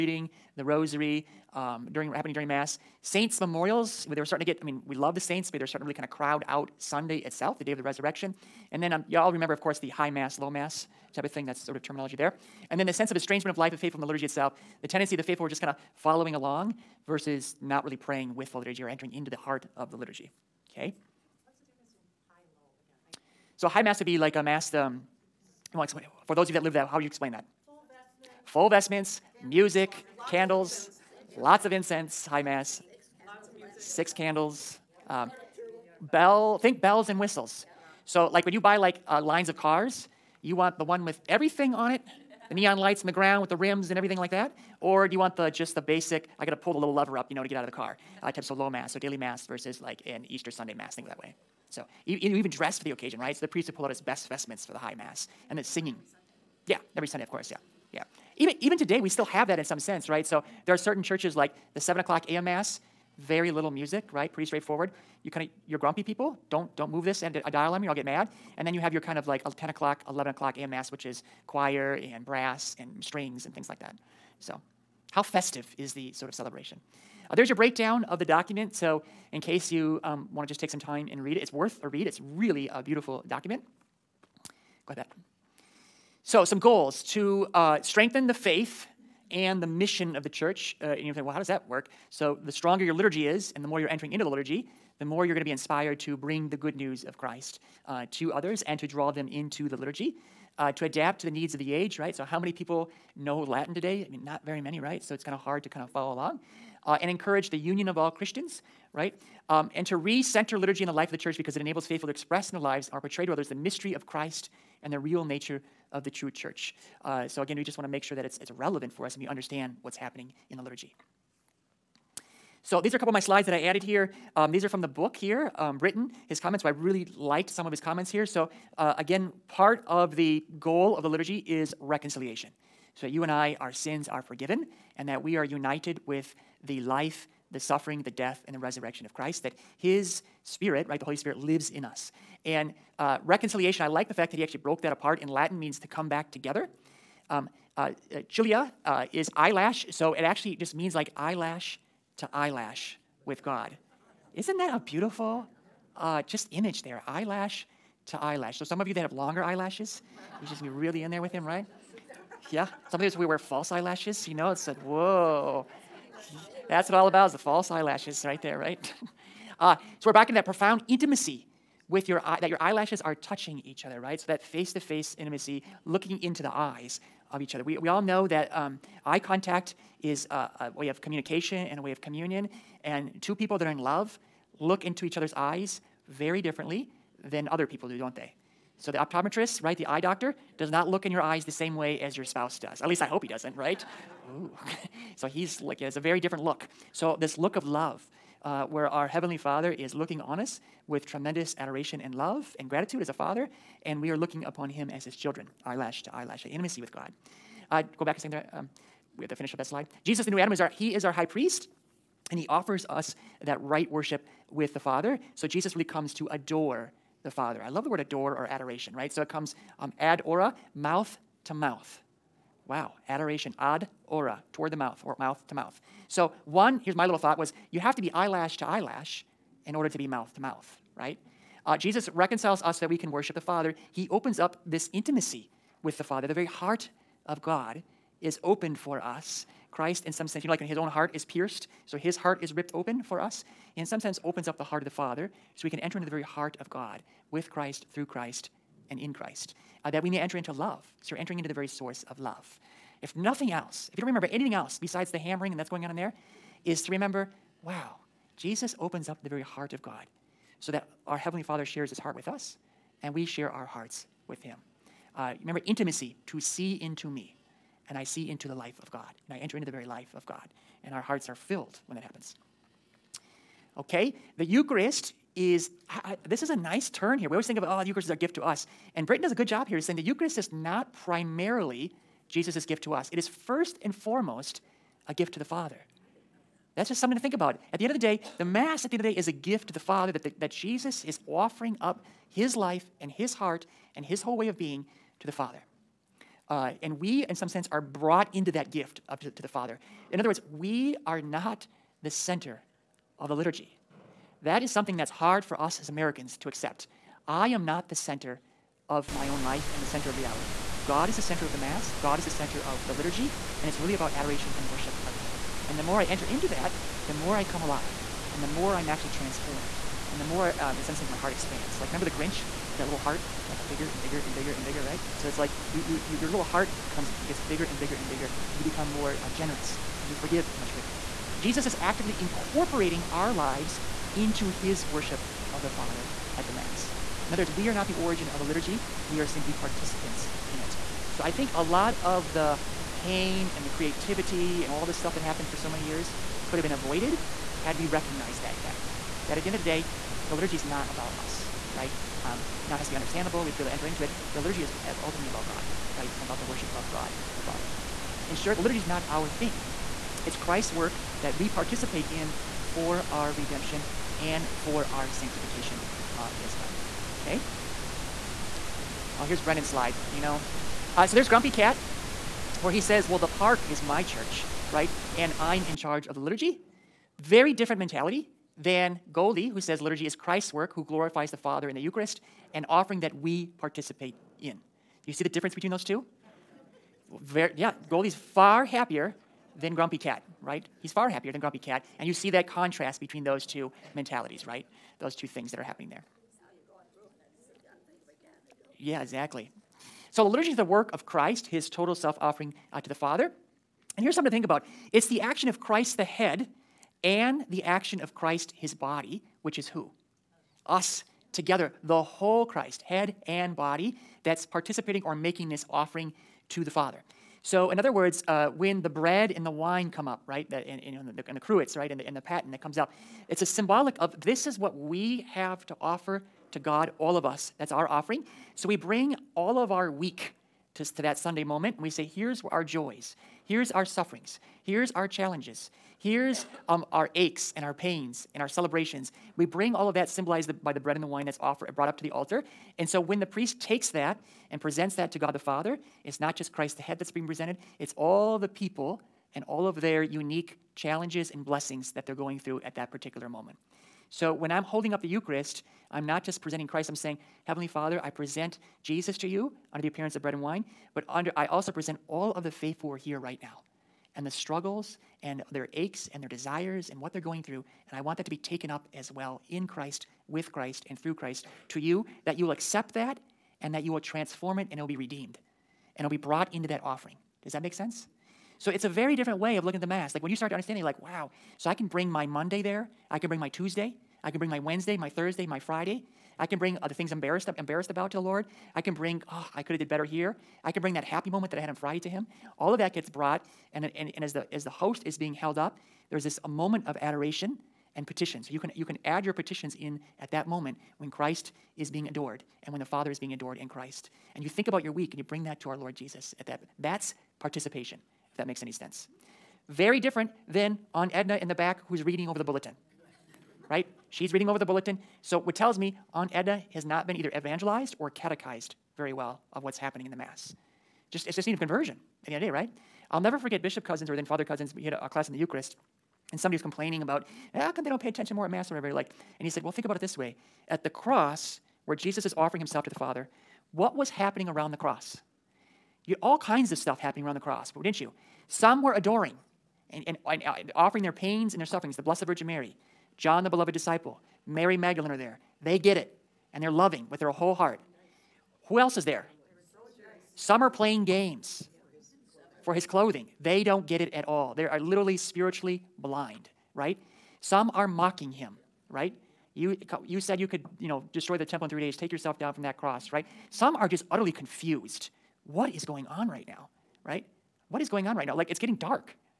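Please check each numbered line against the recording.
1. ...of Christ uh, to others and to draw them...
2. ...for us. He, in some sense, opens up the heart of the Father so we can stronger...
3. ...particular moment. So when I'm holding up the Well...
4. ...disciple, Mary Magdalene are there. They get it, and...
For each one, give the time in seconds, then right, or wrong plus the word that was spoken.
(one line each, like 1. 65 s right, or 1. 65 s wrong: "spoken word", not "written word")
1. 97 s right
2. 243 s wrong: "enter", not "stronger"
3. 452 s wrong: "Eucharist", not "Well"
4. 543 s right.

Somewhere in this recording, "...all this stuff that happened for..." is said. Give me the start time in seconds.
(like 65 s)
344 s.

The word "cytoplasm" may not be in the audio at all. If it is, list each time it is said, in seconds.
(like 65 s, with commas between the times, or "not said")
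not said.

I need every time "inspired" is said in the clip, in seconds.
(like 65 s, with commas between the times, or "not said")
95 s.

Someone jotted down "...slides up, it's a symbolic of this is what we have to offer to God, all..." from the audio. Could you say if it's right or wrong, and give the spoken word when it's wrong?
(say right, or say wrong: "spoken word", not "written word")
wrong: "comes", not "slides".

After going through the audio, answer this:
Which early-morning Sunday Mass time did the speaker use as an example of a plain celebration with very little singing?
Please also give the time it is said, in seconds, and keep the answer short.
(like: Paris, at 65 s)
7 a.m., at 61 s.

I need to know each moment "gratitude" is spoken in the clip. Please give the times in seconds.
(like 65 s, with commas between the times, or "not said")
202 s.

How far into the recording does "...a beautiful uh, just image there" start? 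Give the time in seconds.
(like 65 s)
154 s.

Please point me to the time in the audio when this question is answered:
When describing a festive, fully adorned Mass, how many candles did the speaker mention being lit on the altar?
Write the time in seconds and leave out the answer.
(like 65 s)
33 s.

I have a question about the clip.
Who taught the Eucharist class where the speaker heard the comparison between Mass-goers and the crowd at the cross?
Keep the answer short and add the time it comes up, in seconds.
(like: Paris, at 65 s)
Bishop Cozzens, at 523 s.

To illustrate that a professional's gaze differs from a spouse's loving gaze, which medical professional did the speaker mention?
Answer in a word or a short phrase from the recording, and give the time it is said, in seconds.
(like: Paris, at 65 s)
Optometrist, at 188 s.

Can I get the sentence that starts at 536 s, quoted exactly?
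You had all kinds of stuff happening around the cross, didn't you?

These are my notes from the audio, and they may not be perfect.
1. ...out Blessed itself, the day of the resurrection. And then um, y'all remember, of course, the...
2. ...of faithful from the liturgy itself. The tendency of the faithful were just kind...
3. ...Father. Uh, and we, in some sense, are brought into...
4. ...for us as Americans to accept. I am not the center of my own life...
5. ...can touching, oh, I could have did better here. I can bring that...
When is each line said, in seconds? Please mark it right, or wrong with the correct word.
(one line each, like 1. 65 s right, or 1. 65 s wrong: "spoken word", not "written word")
1. 6 s wrong: "Sunday", not "Blessed"
2. 13 s right
3. 295 s right
4. 305 s right
5. 488 s wrong: "bring", not "touching".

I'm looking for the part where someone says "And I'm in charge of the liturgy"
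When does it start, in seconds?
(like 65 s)
375 s.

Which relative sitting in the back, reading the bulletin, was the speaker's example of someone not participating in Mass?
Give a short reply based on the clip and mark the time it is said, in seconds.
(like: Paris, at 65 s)
Aunt Edna, at 516 s.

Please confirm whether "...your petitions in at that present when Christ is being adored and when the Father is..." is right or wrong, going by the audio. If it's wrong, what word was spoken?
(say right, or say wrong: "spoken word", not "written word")
wrong: "moment", not "present".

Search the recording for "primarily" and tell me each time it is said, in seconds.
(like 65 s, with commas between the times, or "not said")
280 s.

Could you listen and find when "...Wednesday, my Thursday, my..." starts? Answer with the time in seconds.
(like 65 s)
484 s.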